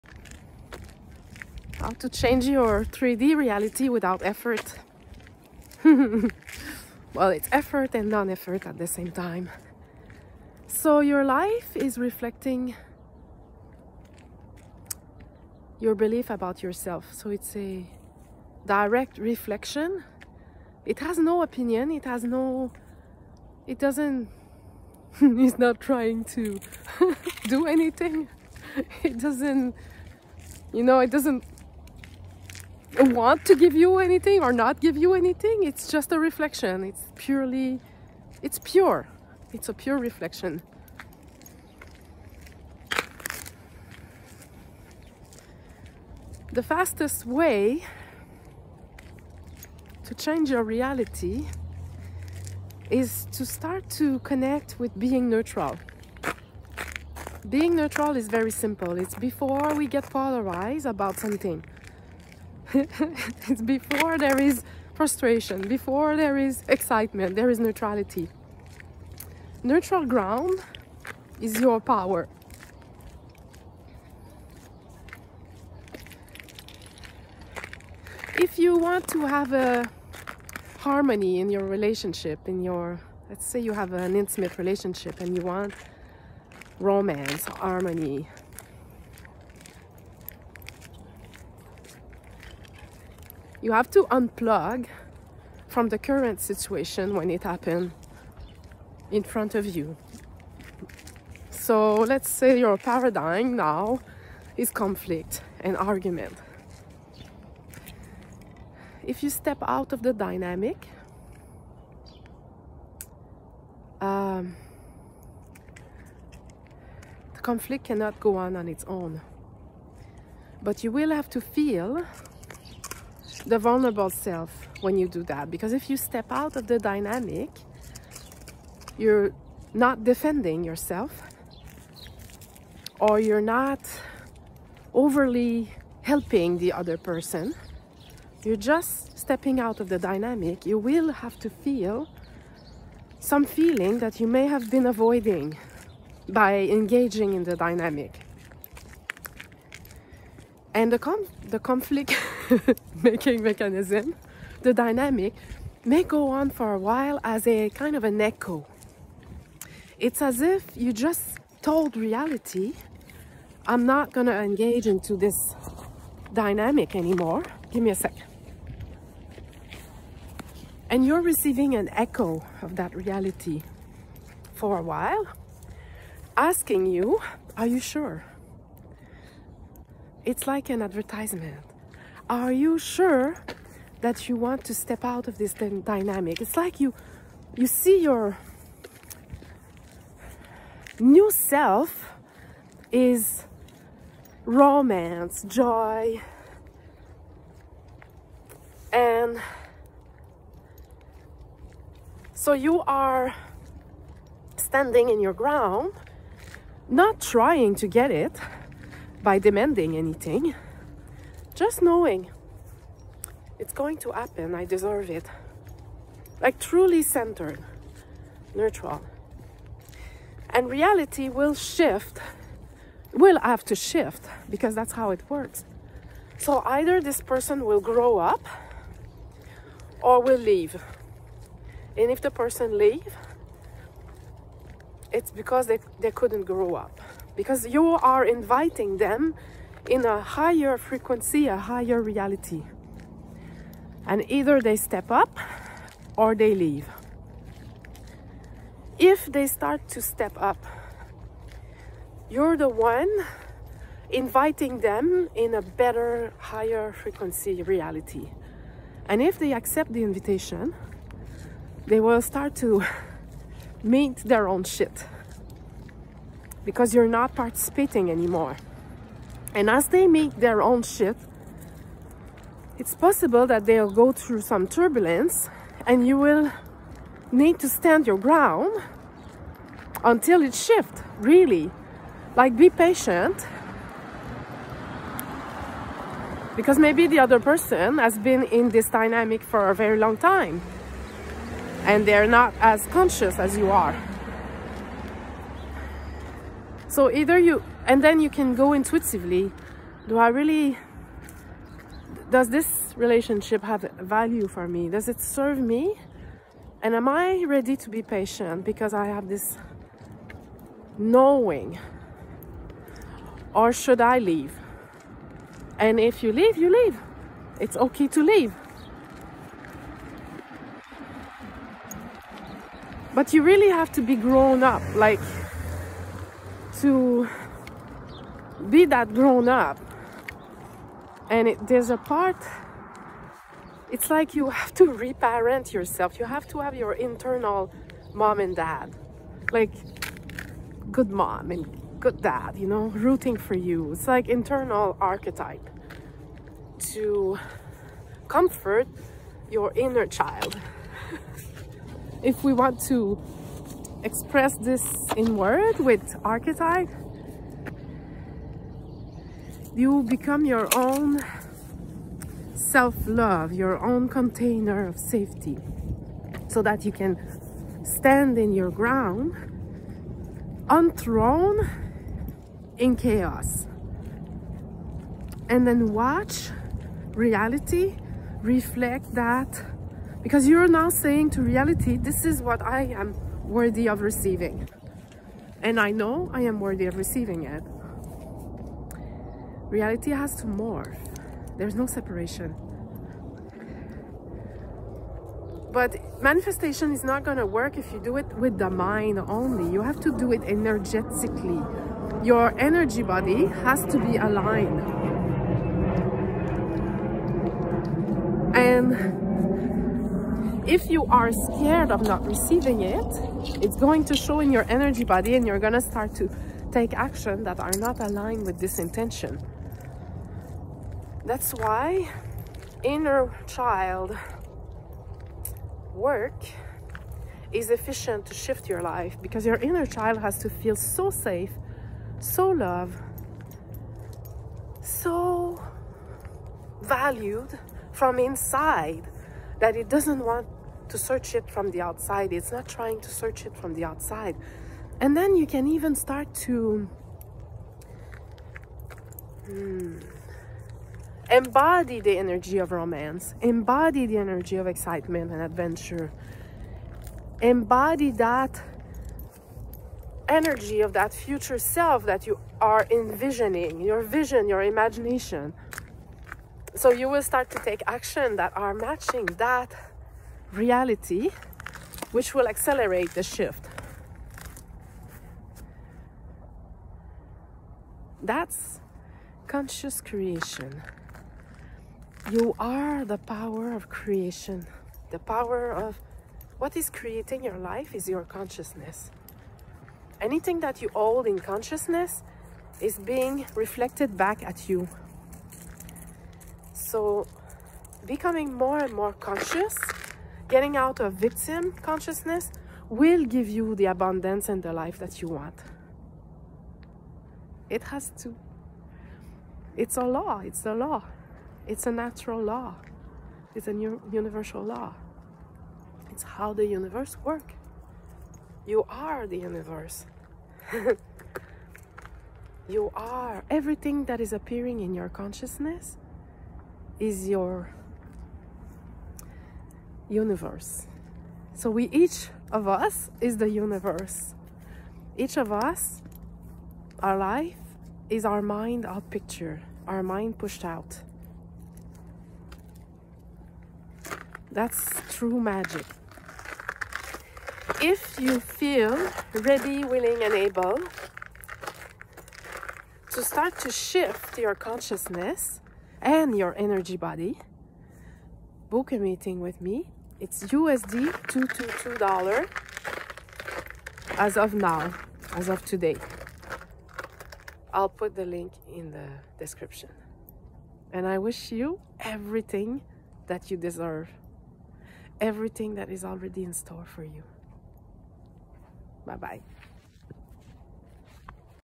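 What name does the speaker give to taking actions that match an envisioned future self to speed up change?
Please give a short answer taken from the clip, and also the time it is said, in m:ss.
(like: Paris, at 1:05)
Conscious creation, at 7:59.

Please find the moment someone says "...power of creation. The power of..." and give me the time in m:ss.
8:03.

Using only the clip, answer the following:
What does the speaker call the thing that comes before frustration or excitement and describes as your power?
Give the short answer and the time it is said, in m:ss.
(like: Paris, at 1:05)
Neutral ground, at 1:09.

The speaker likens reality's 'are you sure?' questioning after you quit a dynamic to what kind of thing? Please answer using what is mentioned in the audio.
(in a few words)
An advertisement.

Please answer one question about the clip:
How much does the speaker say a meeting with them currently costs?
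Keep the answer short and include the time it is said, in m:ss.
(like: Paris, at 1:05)
USD $222, at 9:20.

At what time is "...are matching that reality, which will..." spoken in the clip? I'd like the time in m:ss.
7:48.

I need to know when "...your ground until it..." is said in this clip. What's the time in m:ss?
4:38.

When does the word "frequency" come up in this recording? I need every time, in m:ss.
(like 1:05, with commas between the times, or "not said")
4:00, 4:16.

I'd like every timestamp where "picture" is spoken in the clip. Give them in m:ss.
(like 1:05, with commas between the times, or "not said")
8:59.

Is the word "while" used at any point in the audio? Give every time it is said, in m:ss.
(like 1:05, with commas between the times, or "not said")
2:36, 2:54.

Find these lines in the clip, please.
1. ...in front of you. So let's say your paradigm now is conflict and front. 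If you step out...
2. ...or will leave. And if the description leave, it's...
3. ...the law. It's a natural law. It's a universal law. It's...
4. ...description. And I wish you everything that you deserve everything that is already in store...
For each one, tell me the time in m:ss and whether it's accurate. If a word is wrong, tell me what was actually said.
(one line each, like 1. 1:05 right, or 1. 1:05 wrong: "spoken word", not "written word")
1. 1:39 wrong: "argument", not "front"
2. 3:50 wrong: "person", not "description"
3. 8:30 right
4. 9:29 right.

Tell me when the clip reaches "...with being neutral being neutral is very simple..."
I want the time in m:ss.
0:54.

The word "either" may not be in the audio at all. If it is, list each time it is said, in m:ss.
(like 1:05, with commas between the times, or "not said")
3:46, 4:04, 4:57.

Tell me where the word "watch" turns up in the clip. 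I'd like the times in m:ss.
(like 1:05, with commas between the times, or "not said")
6:15.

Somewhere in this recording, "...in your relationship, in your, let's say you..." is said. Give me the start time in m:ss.
1:21.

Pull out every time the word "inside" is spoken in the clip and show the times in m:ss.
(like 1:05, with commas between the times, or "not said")
7:18.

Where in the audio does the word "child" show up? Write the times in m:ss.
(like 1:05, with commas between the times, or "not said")
5:50, 7:03, 7:09.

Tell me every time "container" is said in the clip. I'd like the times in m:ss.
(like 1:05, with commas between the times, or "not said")
6:04.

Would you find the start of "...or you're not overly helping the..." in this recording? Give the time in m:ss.
2:12.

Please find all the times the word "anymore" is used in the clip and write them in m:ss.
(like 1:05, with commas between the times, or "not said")
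2:46, 4:28.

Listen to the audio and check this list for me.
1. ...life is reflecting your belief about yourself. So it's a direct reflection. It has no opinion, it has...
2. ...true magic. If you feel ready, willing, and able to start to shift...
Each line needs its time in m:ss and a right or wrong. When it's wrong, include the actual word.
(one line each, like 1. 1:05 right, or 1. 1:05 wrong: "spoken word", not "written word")
1. 0:11 right
2. 9:05 right.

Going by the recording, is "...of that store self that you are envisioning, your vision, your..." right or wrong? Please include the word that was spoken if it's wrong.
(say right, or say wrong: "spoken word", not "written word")
wrong: "future", not "store".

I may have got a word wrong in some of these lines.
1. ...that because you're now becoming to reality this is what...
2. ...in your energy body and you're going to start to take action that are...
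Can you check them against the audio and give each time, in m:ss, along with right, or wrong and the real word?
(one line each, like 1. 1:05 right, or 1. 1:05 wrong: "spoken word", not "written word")
1. 6:19 wrong: "saying", not "becoming"
2. 6:54 right.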